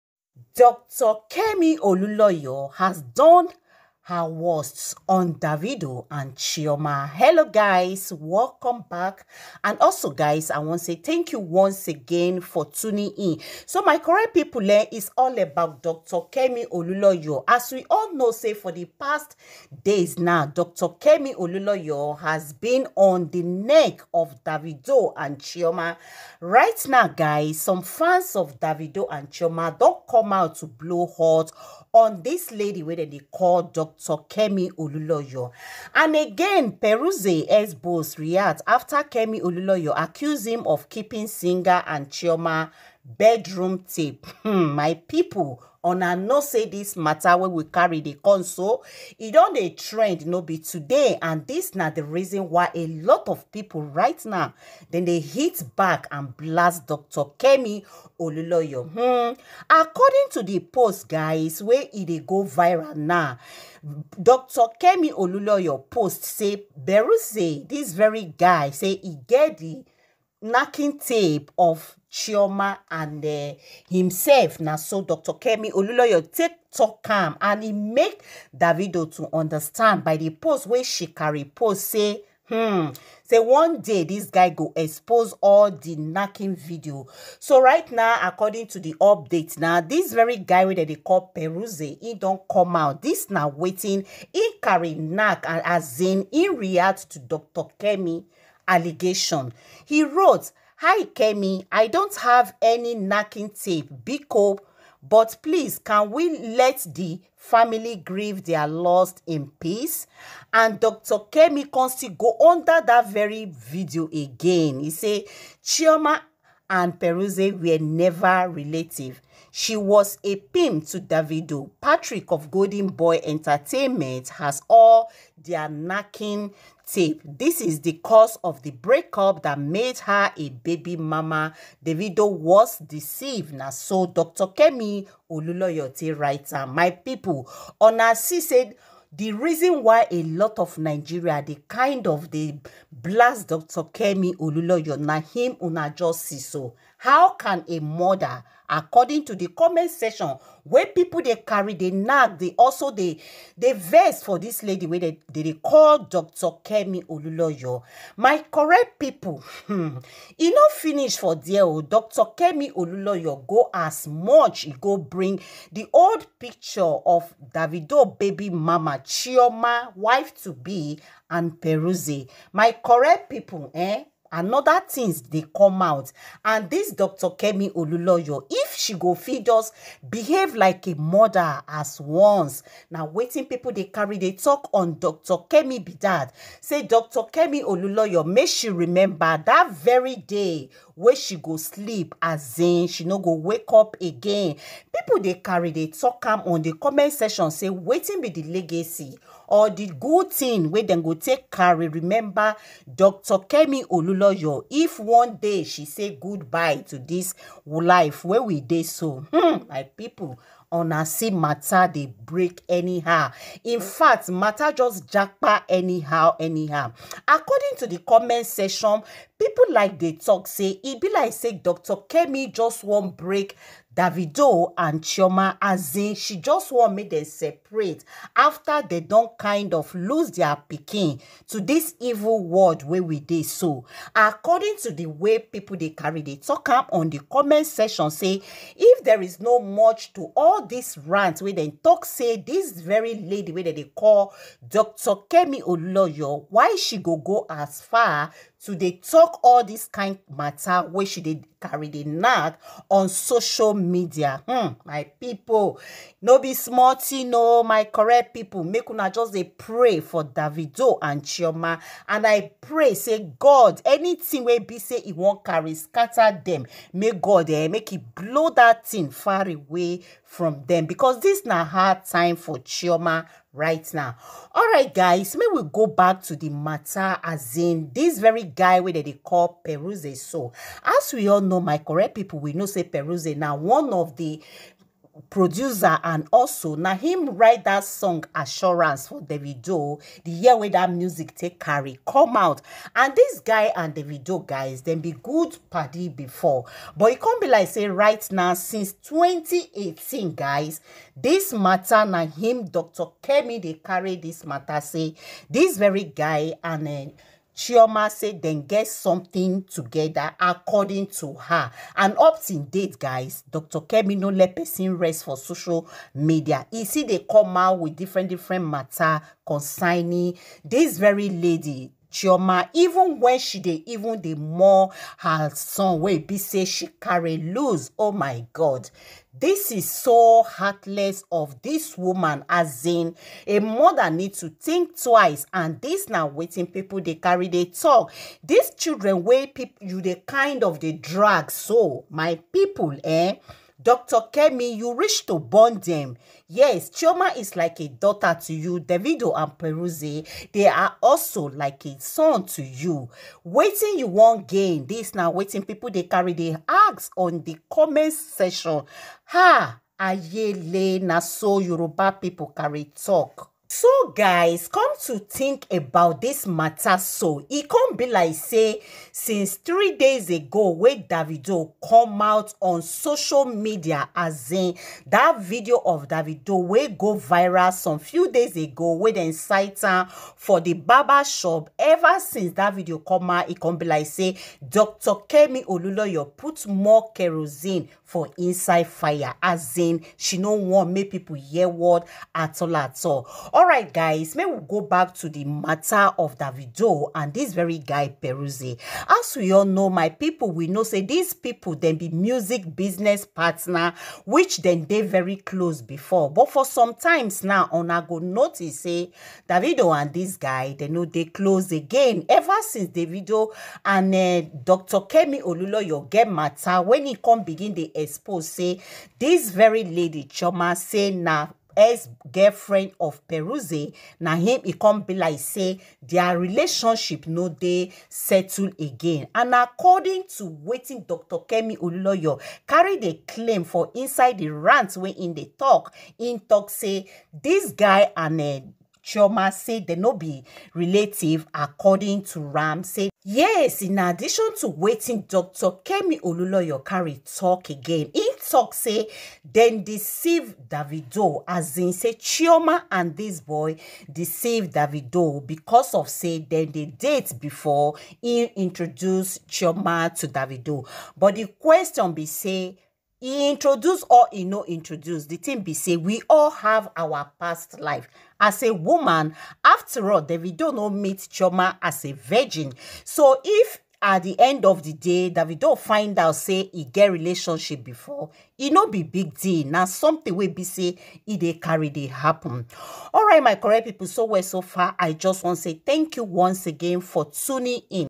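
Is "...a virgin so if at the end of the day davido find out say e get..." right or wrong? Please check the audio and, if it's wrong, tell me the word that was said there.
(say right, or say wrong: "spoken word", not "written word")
right.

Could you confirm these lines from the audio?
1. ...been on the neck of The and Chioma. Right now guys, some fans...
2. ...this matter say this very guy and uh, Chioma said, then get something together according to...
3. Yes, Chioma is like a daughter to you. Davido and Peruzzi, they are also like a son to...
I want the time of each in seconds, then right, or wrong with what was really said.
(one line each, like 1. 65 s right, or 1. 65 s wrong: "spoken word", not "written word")
1. 22 s wrong: "Davido", not "The"
2. 304 s right
3. 346 s right.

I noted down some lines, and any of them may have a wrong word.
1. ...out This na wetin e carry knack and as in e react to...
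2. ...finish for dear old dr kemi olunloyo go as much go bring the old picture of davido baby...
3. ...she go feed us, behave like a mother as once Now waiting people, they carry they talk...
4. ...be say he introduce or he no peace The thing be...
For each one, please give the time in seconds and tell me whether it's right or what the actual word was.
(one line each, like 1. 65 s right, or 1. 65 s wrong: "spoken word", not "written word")
1. 92 s right
2. 160 s right
3. 178 s right
4. 462 s wrong: "introduce", not "peace".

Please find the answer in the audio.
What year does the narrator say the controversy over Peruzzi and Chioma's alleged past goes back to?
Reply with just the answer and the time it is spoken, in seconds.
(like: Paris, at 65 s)
2018, at 298 s.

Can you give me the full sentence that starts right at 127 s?
This is the cause of the breakup that made her a baby mama.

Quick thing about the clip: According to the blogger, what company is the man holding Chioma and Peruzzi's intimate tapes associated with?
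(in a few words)
Golden Boy Entertainment.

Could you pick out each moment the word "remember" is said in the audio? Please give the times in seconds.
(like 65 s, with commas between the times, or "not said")
188 s, 201 s.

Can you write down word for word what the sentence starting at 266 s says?
make god eh make it blow that thing far away from them because this na hard time for chioma right now.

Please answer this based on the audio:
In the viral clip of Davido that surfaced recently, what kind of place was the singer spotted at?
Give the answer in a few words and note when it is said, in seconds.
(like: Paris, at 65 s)
Barber shop, at 380 s.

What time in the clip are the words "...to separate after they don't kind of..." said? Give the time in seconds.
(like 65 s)
227 s.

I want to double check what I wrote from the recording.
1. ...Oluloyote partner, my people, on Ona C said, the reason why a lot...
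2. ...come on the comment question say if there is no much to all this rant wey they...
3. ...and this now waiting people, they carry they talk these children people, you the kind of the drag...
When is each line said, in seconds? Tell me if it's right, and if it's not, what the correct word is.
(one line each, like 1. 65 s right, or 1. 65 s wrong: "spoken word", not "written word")
1. 135 s wrong: "writer", not "partner"
2. 236 s wrong: "section", not "question"
3. 335 s right.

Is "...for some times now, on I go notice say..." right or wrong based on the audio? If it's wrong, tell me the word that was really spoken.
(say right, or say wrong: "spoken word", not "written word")
right.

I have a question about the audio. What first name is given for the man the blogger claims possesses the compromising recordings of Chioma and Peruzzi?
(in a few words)
Patrick.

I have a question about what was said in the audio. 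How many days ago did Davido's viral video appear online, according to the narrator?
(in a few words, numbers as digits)
3.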